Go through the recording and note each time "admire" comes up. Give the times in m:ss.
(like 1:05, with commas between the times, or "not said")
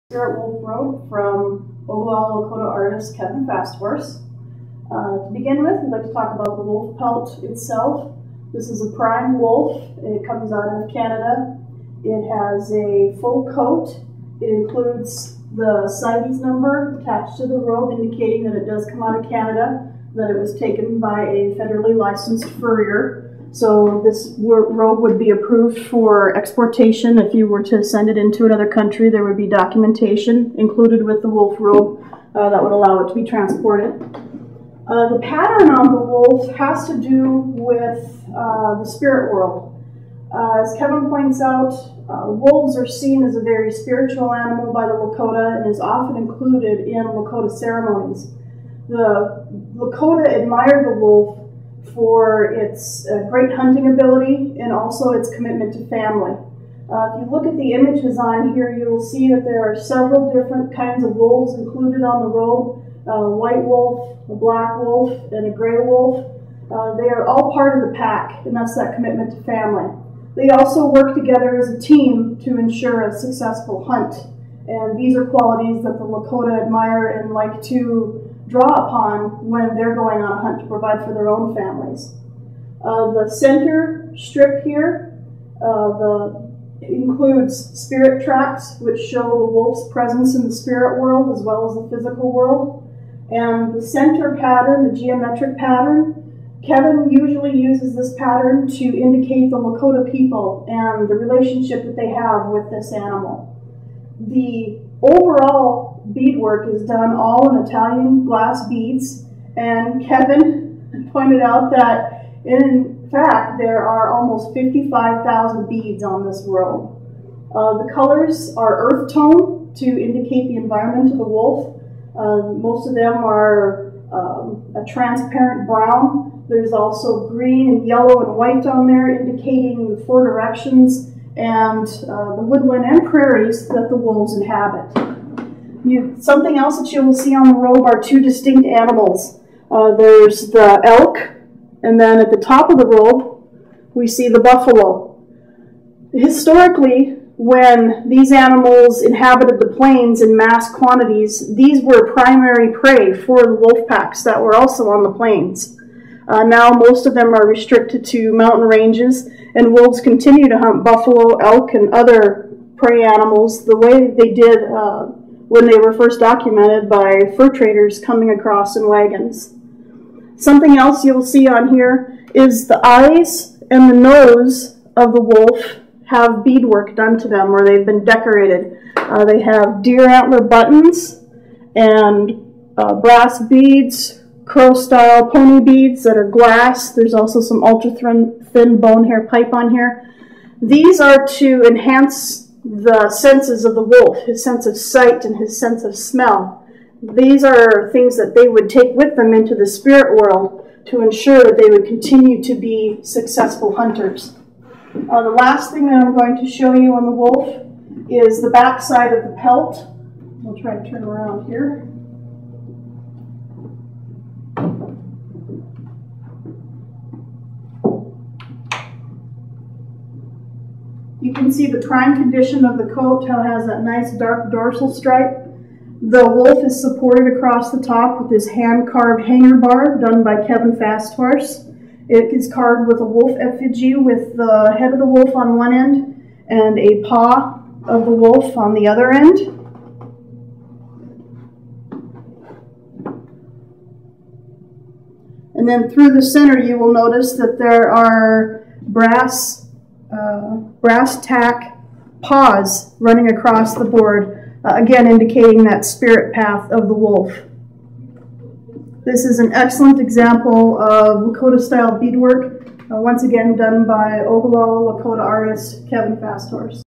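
0:50, 1:16.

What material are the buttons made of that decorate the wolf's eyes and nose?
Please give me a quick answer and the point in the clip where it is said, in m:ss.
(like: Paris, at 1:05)
Deer antler, at 2:59.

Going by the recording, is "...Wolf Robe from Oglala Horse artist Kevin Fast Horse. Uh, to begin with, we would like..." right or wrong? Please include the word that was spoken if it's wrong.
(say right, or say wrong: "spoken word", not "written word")
wrong: "Lakota", not "Horse".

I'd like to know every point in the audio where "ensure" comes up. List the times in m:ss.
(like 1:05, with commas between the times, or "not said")
1:12, 3:21.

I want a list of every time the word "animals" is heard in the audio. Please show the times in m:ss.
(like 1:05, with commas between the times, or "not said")
0:44, 1:42, 2:18, 2:28, 2:43.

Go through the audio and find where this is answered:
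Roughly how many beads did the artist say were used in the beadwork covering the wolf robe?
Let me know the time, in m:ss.
1:54.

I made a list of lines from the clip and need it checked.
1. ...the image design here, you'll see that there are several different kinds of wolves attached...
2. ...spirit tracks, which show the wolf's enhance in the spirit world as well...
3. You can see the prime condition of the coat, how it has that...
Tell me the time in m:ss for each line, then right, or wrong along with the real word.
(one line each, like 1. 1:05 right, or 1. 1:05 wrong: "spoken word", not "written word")
1. 0:57 wrong: "included", not "attached"
2. 1:27 wrong: "presence", not "enhance"
3. 3:41 right.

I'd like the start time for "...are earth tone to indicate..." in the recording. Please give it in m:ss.
1:58.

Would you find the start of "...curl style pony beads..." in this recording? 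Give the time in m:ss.
3:04.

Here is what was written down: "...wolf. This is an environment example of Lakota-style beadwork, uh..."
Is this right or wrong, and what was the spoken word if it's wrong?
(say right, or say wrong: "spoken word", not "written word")
wrong: "excellent", not "environment".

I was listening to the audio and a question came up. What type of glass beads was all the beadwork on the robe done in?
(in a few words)
Italian glass beads.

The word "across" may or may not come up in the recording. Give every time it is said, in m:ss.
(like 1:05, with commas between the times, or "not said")
2:48, 3:47, 4:13.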